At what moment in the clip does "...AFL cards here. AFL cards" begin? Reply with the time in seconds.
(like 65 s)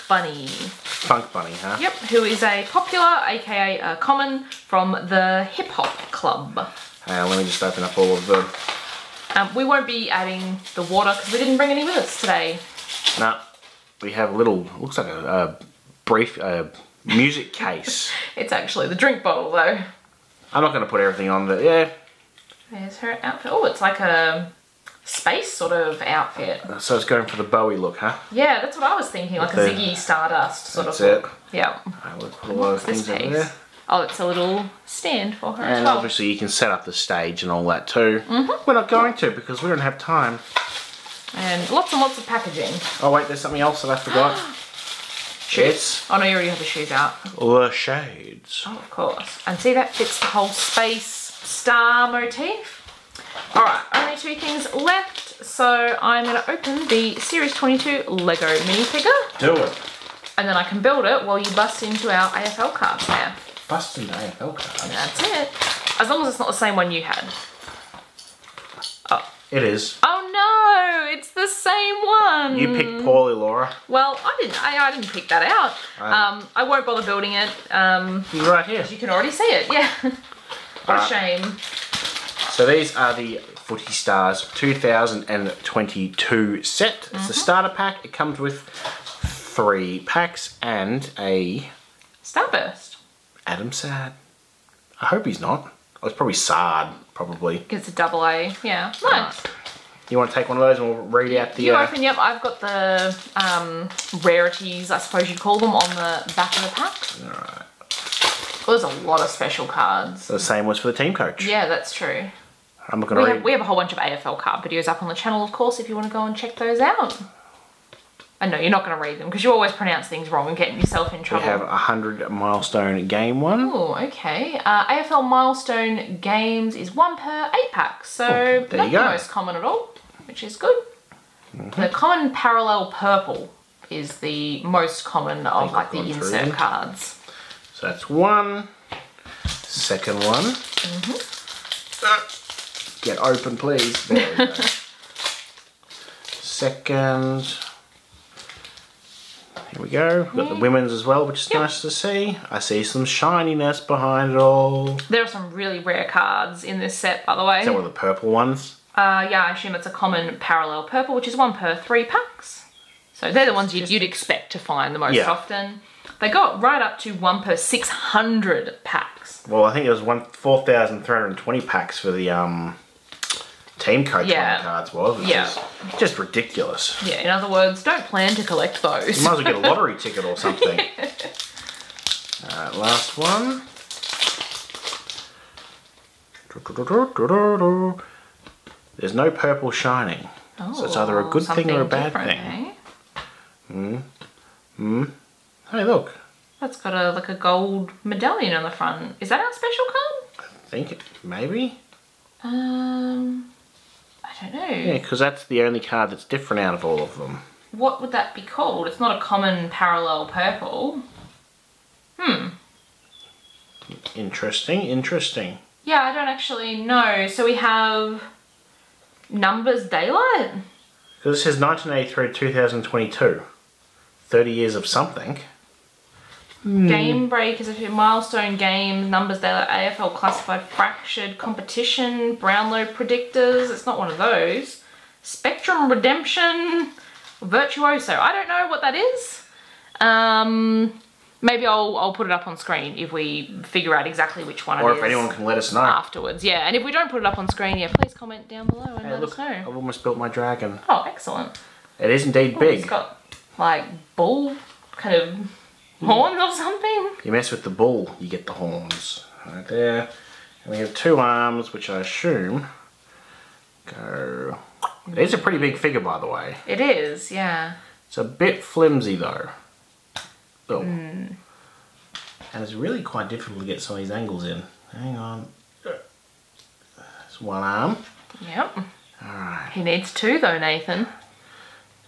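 62 s.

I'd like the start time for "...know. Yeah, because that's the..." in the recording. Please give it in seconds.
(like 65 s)
204 s.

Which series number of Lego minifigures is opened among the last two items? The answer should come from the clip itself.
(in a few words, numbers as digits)
22.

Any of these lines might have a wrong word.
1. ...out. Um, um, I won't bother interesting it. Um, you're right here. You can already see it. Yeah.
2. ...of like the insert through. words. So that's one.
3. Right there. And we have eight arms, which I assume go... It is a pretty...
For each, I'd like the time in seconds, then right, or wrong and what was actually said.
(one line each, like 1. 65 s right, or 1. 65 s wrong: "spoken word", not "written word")
1. 75 s wrong: "building", not "interesting"
2. 135 s wrong: "cards", not "words"
3. 259 s wrong: "two", not "eight".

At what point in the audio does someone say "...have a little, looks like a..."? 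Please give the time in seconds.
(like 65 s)
14 s.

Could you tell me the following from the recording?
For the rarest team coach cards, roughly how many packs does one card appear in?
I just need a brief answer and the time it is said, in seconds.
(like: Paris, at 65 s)
4,320, at 170 s.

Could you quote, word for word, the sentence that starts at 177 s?
Yeah, in other words, don't plan to collect those.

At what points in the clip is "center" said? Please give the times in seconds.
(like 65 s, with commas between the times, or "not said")
not said.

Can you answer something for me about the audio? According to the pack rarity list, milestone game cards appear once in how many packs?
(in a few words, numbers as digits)
8.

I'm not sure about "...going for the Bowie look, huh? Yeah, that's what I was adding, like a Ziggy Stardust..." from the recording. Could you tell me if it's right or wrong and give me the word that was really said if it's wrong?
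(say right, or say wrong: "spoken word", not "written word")
wrong: "thinking", not "adding".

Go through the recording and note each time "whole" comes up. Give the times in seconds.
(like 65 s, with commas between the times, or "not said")
50 s, 113 s.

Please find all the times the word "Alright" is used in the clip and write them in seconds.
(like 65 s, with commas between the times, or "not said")
107 s, 182 s, 279 s.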